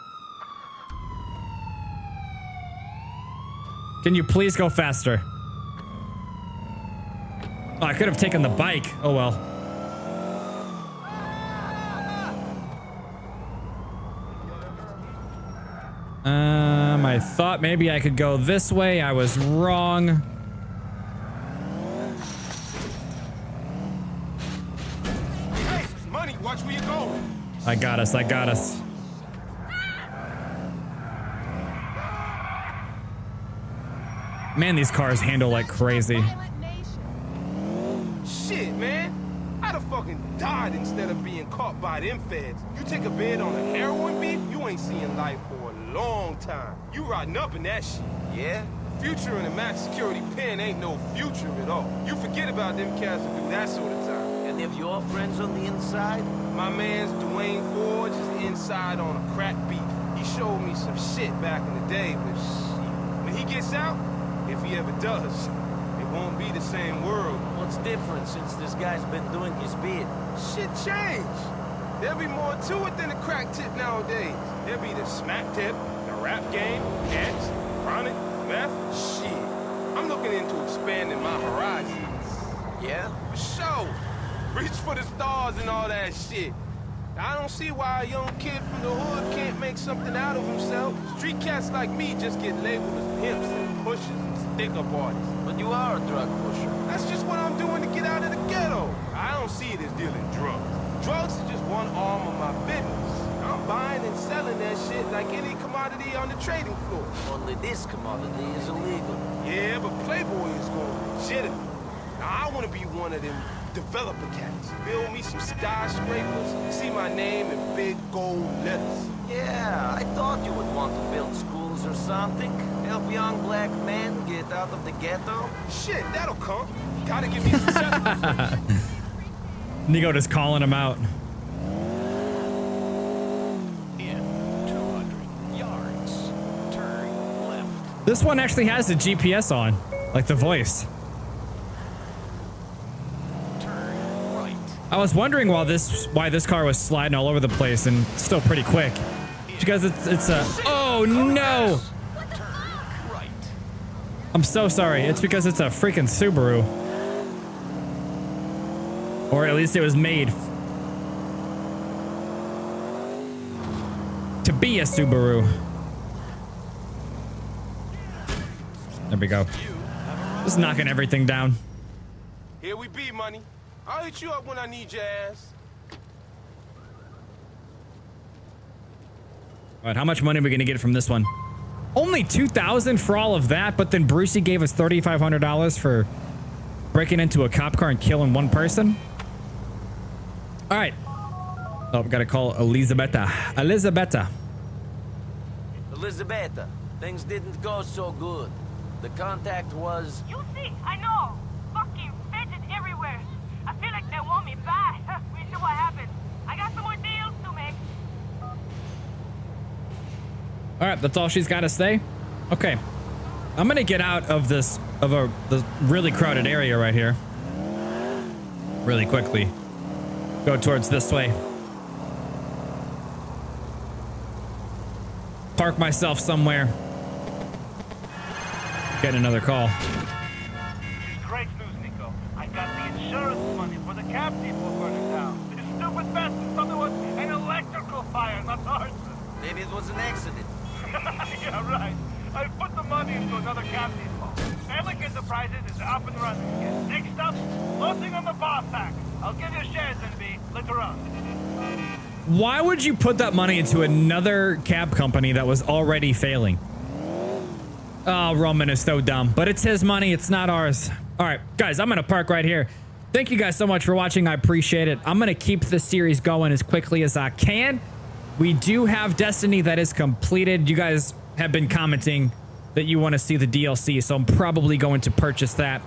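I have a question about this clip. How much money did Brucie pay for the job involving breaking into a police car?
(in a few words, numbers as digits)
$3,500.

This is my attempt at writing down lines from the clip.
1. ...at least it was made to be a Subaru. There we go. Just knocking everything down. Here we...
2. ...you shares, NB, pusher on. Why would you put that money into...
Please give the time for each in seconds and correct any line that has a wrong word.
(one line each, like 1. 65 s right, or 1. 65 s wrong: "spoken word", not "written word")
1. 159 s right
2. 249 s wrong: "later", not "pusher".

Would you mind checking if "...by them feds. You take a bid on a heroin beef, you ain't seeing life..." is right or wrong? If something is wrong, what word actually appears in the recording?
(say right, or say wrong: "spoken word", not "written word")
right.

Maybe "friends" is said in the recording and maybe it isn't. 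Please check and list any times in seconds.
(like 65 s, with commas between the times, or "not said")
55 s.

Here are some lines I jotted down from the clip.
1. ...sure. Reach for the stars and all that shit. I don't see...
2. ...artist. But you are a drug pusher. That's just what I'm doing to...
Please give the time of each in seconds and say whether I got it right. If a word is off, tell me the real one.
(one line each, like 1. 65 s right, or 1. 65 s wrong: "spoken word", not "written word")
1. 83 s right
2. 94 s right.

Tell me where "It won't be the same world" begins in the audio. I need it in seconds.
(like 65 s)
65 s.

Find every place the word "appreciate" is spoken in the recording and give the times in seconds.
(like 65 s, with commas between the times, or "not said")
264 s.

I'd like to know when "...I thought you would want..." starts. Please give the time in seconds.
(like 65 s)
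119 s.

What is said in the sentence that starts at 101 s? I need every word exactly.
Drugs is just one arm of my business.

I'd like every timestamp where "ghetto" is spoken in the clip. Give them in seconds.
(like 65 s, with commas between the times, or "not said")
98 s, 124 s.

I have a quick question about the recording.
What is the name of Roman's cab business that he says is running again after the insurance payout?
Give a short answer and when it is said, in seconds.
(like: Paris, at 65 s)
Bellic Enterprises, at 244 s.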